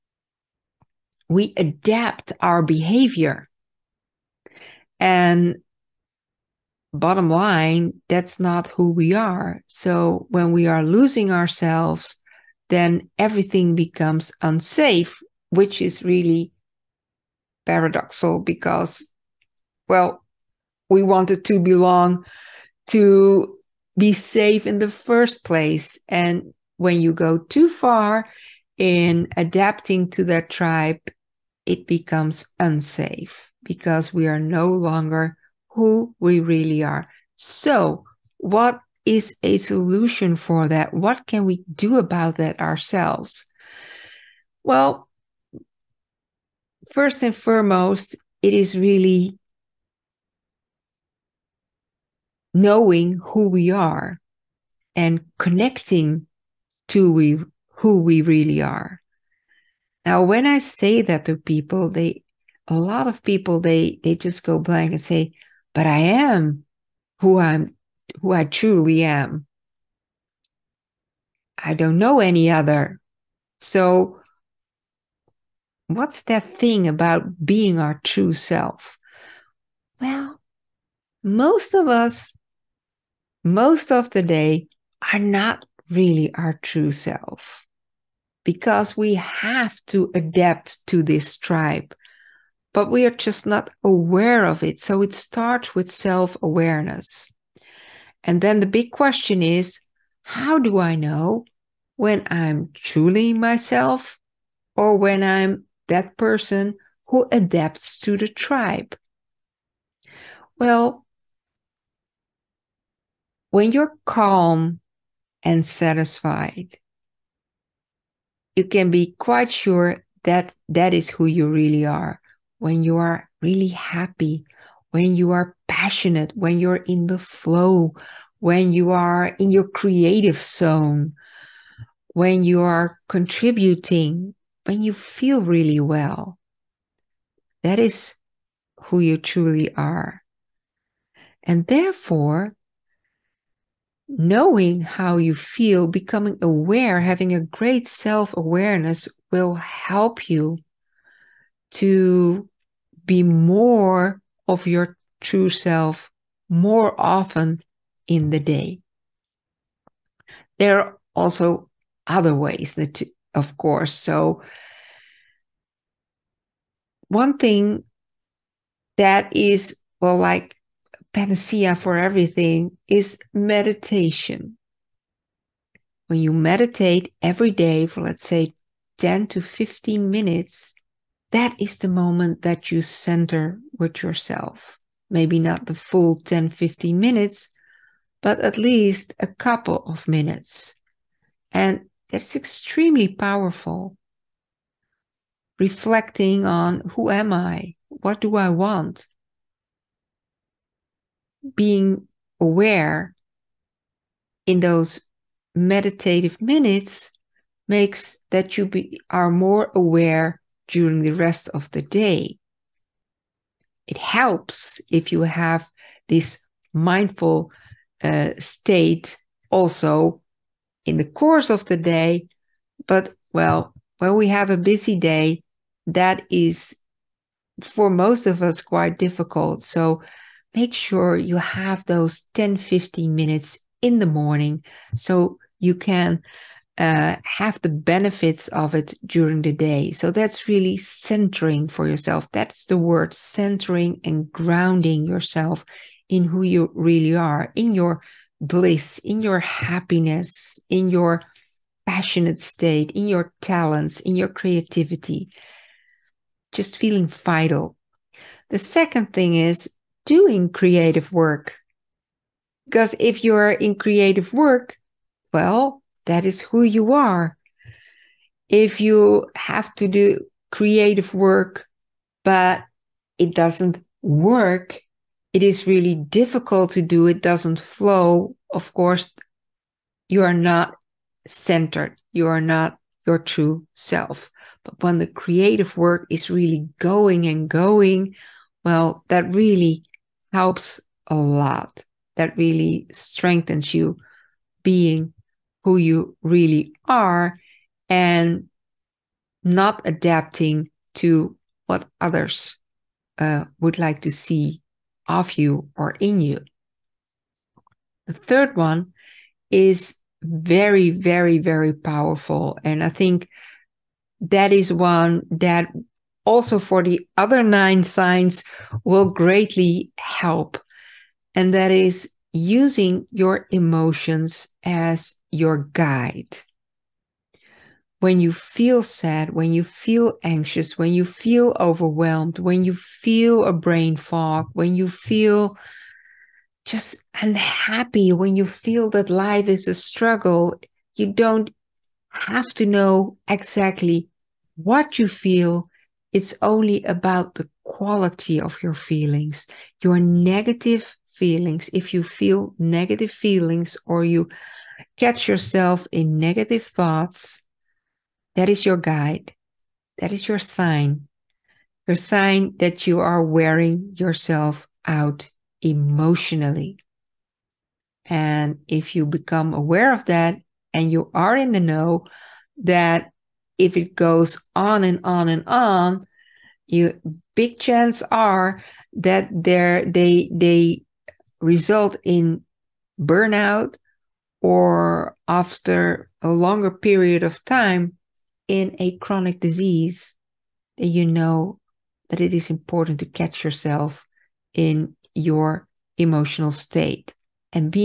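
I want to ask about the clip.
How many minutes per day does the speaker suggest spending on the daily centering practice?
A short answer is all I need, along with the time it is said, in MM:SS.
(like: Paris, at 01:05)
10 to 15 minutes, at 02:58.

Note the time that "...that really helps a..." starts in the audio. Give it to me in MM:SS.
04:49.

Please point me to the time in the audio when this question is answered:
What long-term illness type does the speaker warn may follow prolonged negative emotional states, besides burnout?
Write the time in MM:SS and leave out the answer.
06:28.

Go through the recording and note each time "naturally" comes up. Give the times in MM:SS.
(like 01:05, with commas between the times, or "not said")
not said.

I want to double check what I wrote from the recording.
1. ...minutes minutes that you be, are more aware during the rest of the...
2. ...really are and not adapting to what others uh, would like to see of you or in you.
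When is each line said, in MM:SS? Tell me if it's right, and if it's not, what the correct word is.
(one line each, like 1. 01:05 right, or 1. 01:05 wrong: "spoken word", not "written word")
1. 03:26 wrong: "makes", not "minutes"
2. 04:56 right.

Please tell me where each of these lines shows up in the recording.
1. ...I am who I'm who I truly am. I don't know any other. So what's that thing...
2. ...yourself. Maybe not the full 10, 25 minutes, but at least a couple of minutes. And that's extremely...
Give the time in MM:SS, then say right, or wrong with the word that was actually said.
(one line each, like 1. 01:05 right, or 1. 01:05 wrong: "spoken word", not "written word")
1. 01:05 right
2. 03:04 wrong: "15", not "25".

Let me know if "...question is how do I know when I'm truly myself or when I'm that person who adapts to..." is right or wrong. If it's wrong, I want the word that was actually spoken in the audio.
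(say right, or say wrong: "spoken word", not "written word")
right.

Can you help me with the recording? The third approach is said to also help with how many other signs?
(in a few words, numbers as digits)
9.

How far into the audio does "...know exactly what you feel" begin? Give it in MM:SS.
05:42.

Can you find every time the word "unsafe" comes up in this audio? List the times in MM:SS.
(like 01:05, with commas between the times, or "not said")
00:14, 00:32.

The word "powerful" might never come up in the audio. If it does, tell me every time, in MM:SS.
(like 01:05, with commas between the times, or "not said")
03:13, 05:11.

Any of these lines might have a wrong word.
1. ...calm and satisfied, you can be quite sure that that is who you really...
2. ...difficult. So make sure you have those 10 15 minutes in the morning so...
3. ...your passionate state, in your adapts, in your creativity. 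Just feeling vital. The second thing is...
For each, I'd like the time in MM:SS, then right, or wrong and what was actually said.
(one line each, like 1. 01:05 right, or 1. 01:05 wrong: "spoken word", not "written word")
1. 01:54 right
2. 03:48 right
3. 04:10 wrong: "talents", not "adapts".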